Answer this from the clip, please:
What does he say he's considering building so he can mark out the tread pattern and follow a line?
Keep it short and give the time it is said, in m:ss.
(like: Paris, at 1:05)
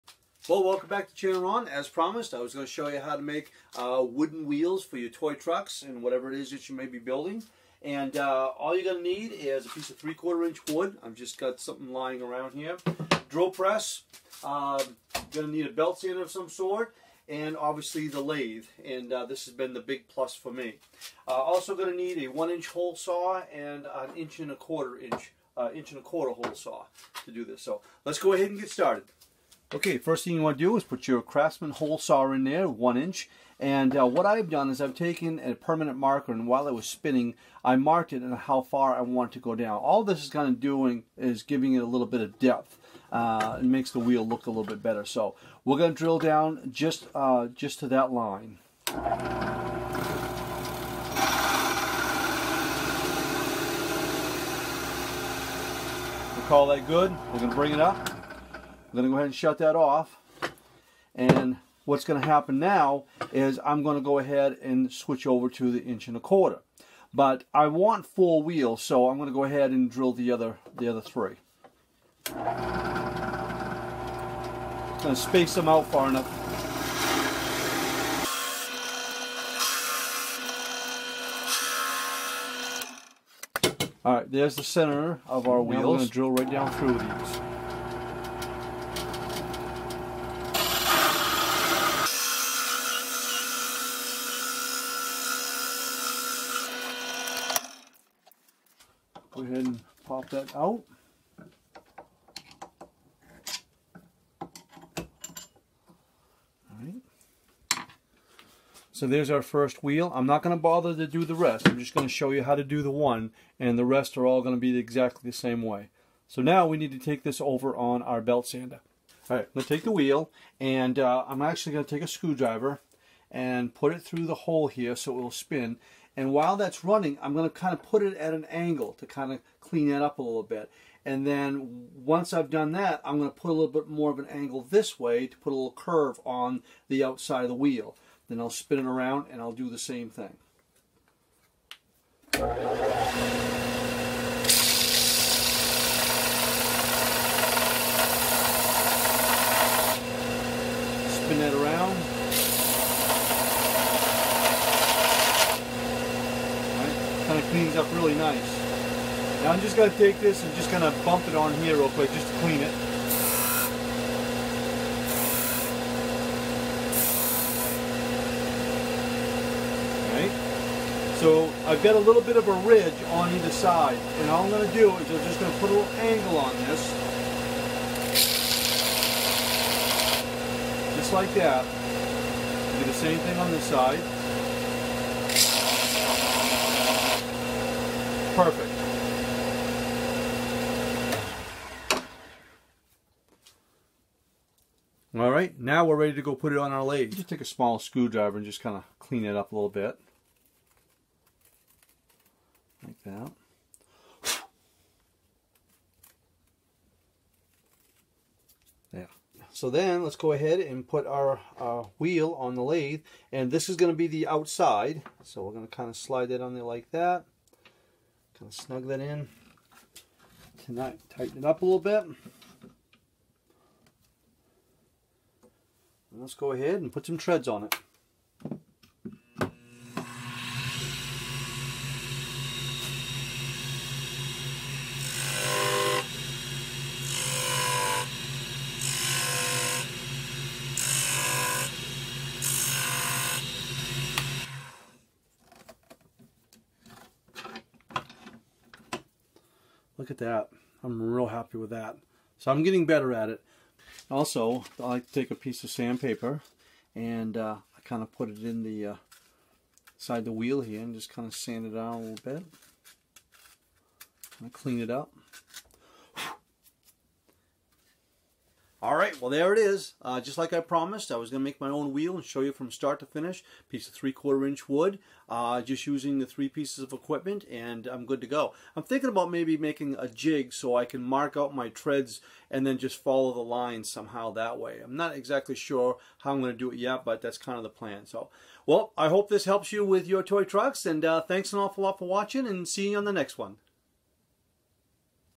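A jig, at 4:39.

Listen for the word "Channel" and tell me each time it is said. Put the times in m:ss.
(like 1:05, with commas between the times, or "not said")
0:01.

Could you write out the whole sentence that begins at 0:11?
I've just got something lying around here.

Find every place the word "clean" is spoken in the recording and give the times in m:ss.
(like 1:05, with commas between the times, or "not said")
2:09, 2:37, 2:42, 3:18, 4:24.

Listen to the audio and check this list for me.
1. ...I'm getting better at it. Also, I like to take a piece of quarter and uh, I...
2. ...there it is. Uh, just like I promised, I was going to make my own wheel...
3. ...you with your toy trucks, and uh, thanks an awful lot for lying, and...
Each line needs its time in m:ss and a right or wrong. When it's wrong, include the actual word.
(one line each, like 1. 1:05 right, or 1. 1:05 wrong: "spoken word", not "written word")
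1. 4:12 wrong: "sandpaper", not "quarter"
2. 4:29 right
3. 4:49 wrong: "watching", not "lying".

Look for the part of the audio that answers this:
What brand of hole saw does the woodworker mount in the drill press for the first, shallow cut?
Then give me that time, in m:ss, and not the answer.
0:31.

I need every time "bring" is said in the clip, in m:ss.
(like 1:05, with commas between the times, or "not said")
0:57.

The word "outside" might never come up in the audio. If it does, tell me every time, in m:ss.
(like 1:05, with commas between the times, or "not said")
2:17, 3:34.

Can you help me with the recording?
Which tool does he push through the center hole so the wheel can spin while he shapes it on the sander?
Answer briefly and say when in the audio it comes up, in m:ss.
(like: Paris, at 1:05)
A screwdriver, at 2:02.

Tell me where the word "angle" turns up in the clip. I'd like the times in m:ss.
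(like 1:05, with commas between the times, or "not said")
2:08, 2:14, 2:55.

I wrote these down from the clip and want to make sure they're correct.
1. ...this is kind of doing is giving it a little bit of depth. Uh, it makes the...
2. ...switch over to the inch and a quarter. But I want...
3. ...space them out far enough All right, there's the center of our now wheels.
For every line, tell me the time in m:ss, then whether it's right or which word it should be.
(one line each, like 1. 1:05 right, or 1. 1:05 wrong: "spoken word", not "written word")
1. 0:40 right
2. 1:04 right
3. 1:15 right.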